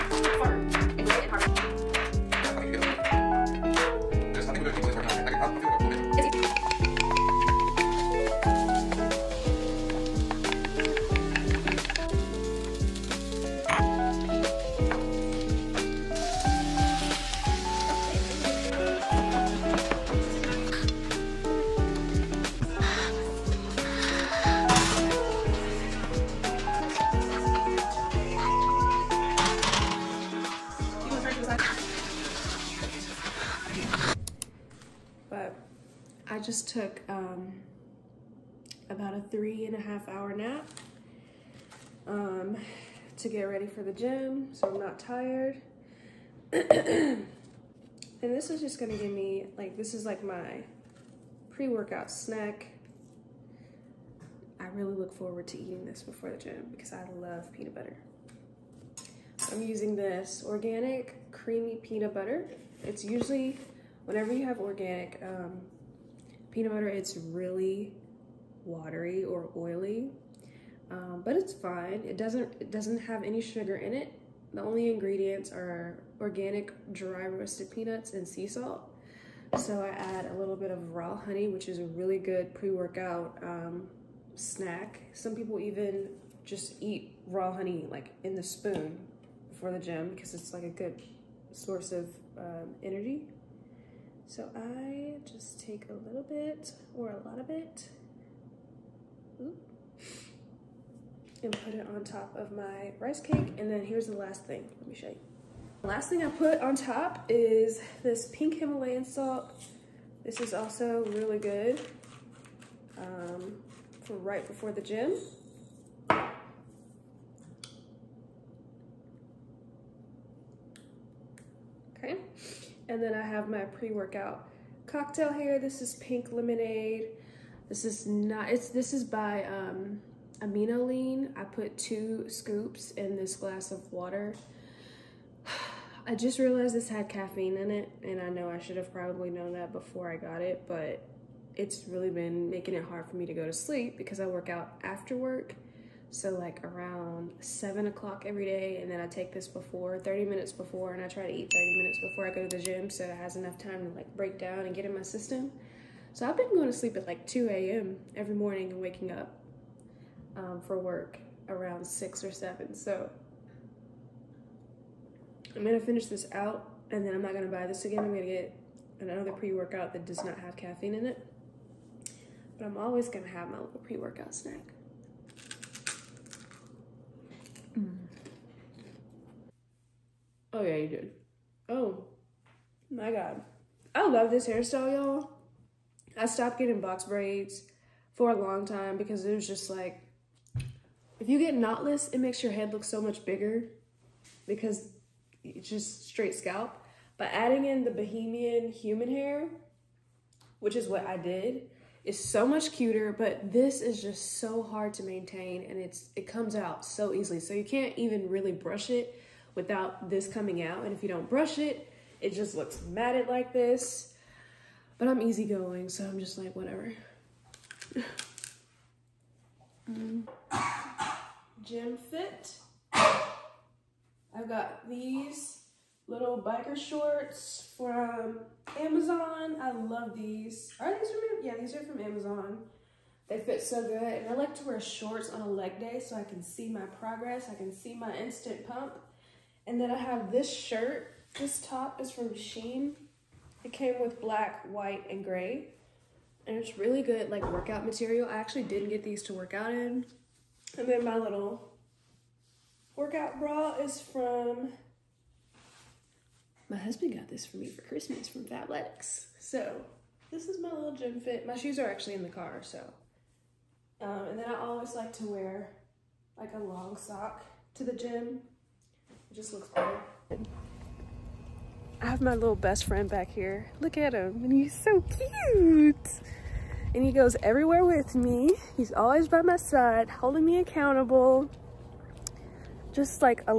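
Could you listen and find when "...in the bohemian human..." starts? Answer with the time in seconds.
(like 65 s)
197 s.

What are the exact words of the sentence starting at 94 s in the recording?
So I just take a little bit or a lot of it and put it on top of my rice cake.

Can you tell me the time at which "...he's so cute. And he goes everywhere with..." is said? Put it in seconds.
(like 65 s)
274 s.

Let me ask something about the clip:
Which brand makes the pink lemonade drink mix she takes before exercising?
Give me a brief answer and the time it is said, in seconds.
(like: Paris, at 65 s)
Amino Lean, at 130 s.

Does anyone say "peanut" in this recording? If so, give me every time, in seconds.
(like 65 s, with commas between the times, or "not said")
57 s, 61 s, 66 s, 77 s.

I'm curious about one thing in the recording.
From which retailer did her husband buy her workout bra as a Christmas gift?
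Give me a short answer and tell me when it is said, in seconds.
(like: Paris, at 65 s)
Fabletics, at 258 s.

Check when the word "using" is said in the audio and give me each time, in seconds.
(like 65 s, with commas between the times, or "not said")
59 s.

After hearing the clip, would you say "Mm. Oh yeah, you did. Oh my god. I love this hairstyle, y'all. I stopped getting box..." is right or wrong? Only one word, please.
right.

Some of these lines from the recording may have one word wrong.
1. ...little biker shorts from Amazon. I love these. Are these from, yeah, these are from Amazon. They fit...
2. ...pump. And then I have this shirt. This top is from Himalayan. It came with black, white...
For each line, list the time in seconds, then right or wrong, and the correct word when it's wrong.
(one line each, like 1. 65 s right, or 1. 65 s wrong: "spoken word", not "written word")
1. 226 s right
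2. 238 s wrong: "Shein", not "Himalayan".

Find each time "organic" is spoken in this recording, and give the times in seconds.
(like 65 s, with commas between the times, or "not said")
60 s, 64 s, 76 s.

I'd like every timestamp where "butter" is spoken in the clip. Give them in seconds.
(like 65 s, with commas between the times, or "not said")
57 s, 62 s, 66 s.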